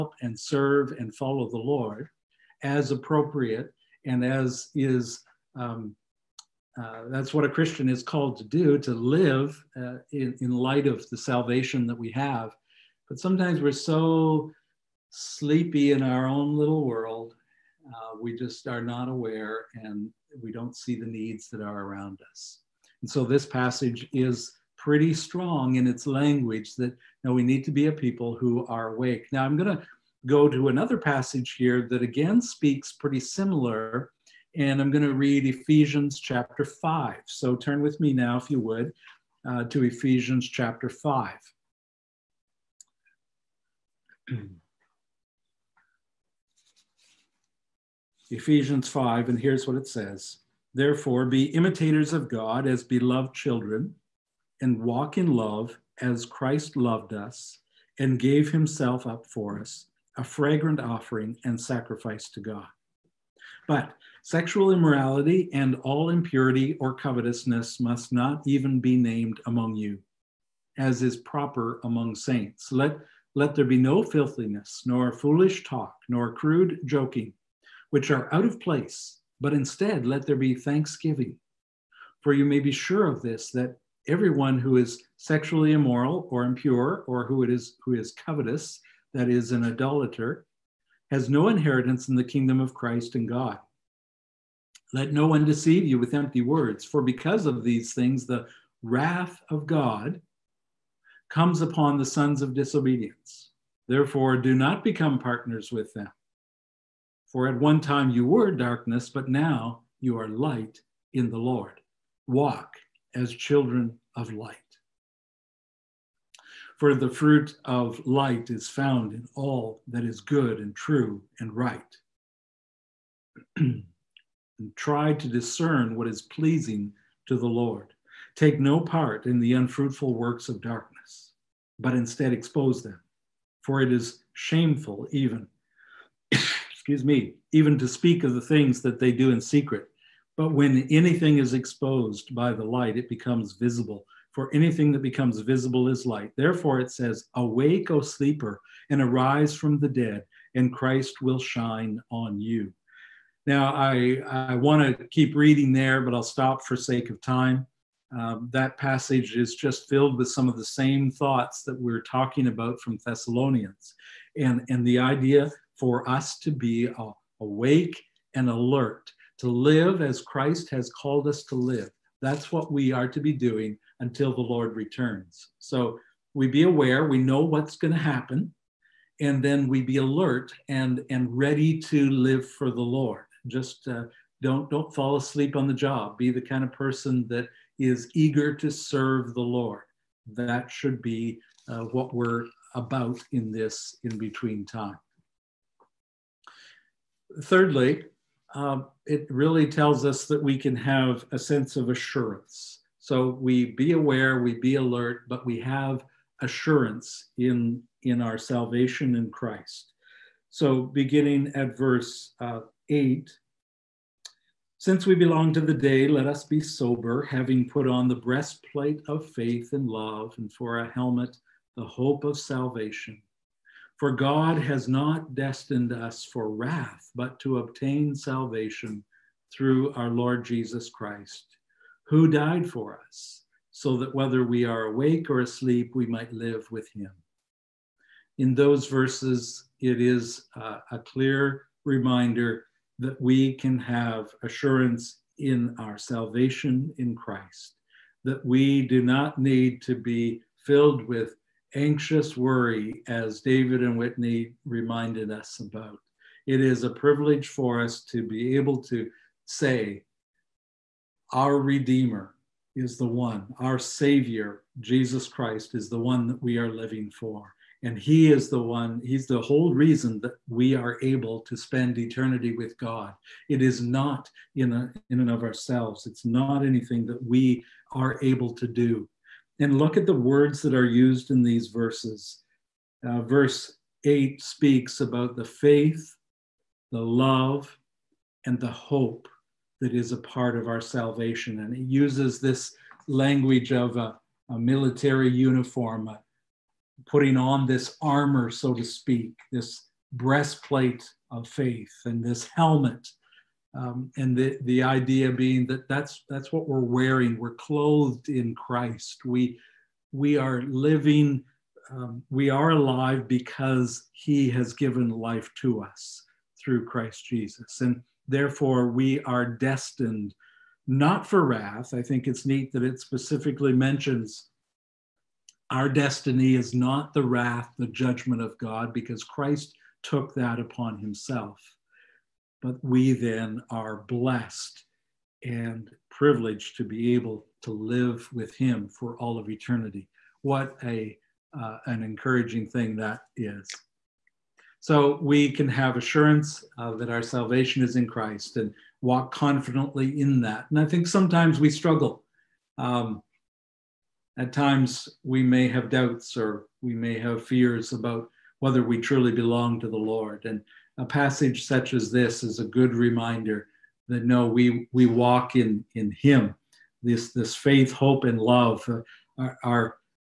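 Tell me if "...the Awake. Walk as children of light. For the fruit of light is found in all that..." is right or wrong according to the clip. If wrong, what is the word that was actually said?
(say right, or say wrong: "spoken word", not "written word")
wrong: "Lord", not "Awake".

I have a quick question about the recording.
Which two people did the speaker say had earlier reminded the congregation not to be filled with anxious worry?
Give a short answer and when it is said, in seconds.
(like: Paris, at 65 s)
David and Whitney, at 253 s.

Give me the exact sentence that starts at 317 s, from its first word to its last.
And therefore, we are destined not for wrath.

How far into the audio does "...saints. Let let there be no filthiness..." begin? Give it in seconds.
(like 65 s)
72 s.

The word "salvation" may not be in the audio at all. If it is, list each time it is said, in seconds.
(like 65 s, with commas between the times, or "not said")
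11 s, 208 s, 222 s, 228 s, 245 s, 290 s, 347 s.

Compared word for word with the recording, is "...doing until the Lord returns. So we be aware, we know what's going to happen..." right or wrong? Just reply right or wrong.
right.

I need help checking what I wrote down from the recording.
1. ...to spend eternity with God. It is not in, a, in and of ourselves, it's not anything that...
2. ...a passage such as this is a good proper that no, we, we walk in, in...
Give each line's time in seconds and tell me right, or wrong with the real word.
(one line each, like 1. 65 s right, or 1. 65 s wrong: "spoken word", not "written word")
1. 271 s right
2. 360 s wrong: "reminder", not "proper".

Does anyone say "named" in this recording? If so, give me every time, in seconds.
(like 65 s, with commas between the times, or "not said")
68 s.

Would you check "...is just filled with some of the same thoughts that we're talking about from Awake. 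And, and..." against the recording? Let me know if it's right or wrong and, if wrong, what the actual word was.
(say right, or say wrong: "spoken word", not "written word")
wrong: "Thessalonians", not "Awake".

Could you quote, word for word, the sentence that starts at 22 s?
And so this passage is pretty strong in its language that you now we need to be a people who are awake.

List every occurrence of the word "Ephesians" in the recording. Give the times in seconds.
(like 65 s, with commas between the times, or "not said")
35 s, 39 s, 48 s.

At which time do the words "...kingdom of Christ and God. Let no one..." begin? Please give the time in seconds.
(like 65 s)
92 s.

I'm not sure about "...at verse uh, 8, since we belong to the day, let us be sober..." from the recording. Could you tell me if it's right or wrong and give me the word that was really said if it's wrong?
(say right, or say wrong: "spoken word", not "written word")
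right.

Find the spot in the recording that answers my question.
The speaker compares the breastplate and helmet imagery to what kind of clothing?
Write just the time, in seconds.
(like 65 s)
294 s.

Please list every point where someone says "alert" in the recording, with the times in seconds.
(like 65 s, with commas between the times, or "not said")
168 s, 179 s, 204 s.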